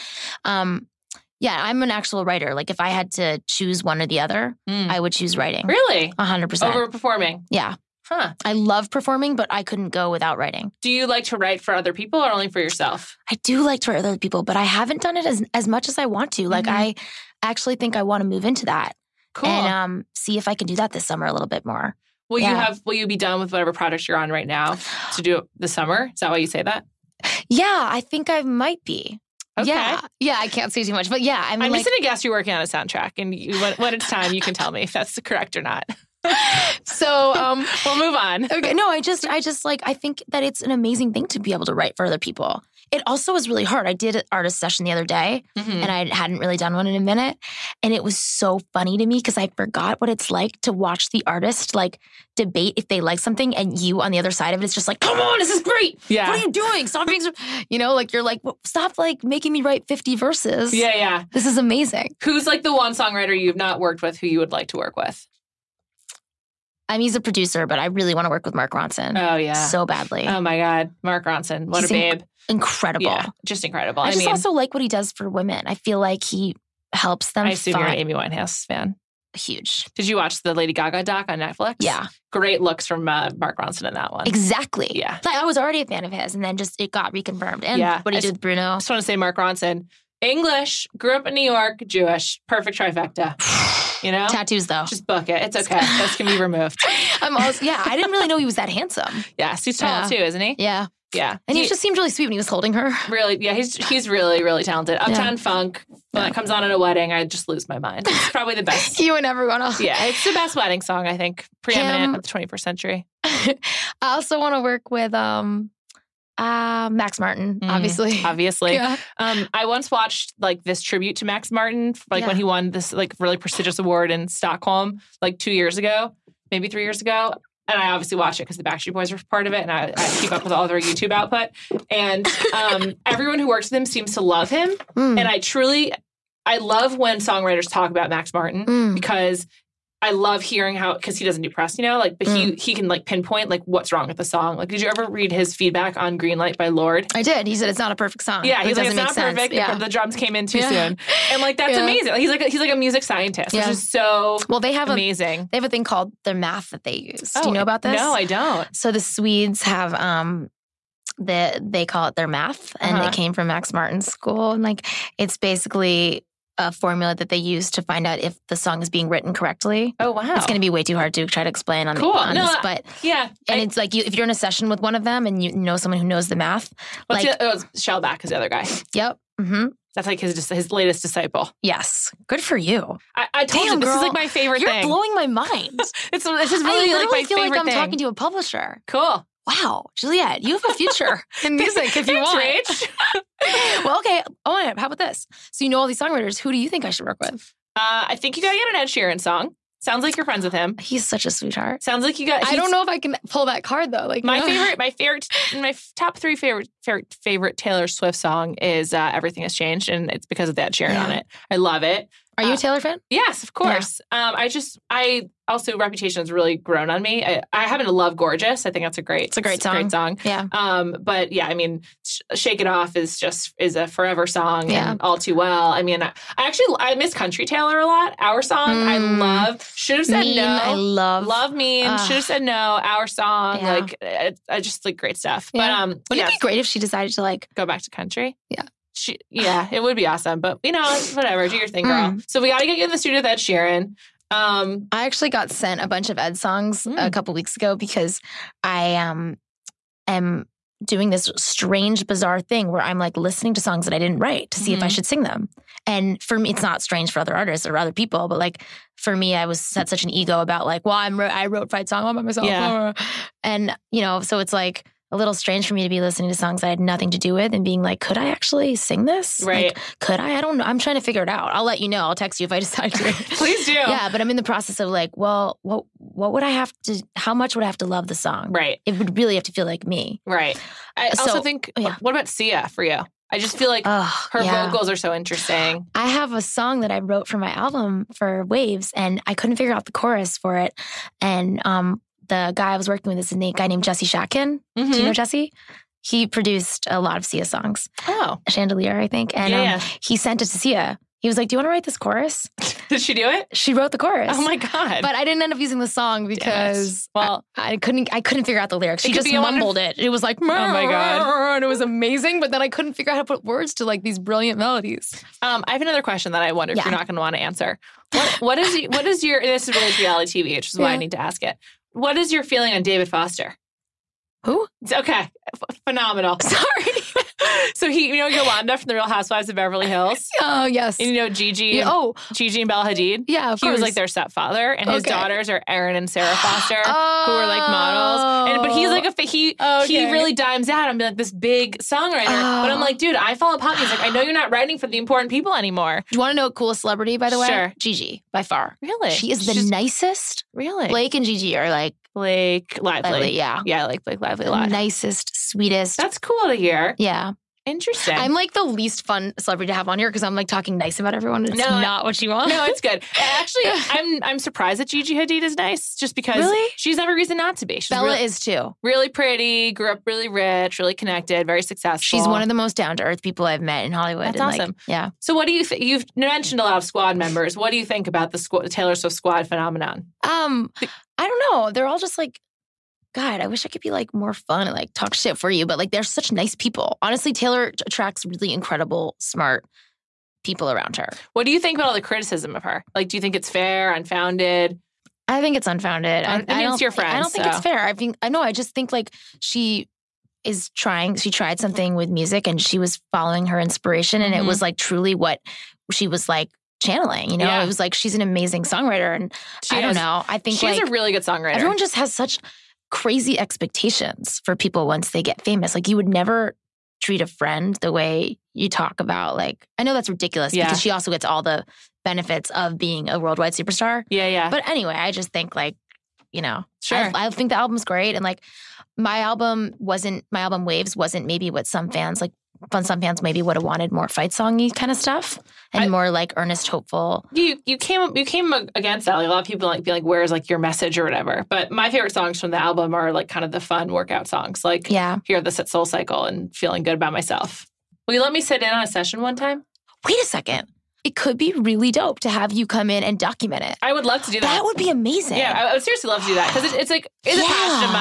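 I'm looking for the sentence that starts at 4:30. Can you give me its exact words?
I'm trying to figure it out.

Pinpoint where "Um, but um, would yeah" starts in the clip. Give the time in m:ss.
3:55.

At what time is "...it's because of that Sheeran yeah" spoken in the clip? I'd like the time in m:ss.
3:30.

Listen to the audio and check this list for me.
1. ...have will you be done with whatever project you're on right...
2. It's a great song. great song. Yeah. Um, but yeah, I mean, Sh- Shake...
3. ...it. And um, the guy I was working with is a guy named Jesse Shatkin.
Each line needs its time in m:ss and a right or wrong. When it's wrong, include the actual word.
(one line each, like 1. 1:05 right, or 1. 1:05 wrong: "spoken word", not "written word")
1. 0:22 right
2. 3:39 right
3. 4:50 right.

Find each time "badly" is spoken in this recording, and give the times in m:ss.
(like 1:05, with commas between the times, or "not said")
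1:09.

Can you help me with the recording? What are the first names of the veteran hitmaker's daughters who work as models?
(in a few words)
Erin and Sara.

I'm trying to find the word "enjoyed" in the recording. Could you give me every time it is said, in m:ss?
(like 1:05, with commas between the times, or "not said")
not said.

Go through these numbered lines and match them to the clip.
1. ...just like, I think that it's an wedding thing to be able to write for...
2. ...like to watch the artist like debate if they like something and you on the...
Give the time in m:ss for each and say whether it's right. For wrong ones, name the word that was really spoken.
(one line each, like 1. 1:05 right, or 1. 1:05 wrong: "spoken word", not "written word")
1. 0:39 wrong: "amazing", not "wedding"
2. 0:50 right.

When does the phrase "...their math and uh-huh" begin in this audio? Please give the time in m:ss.
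2:42.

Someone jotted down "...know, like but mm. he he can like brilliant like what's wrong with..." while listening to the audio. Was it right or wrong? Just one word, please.
wrong.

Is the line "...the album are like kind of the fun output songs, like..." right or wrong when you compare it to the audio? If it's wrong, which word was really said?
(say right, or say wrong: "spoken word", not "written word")
wrong: "workout", not "output".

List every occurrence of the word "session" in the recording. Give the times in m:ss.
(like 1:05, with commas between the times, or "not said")
0:44, 2:54, 7:28.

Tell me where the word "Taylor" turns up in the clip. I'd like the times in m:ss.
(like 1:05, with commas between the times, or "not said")
3:27, 3:32, 3:47, 6:18, 6:27.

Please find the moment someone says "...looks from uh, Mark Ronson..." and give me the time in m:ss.
1:22.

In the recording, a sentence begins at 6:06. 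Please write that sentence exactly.
she's every reason not to be.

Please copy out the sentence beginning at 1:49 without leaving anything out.
Yeah, it's the best wedding song I think, preeminent Him.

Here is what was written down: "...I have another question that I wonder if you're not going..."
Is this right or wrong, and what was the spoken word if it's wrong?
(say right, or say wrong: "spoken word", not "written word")
right.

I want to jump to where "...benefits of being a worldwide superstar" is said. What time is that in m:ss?
7:02.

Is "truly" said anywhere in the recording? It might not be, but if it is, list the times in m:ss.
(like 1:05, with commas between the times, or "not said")
2:15, 6:44.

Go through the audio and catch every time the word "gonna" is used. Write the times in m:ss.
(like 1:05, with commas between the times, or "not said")
0:31.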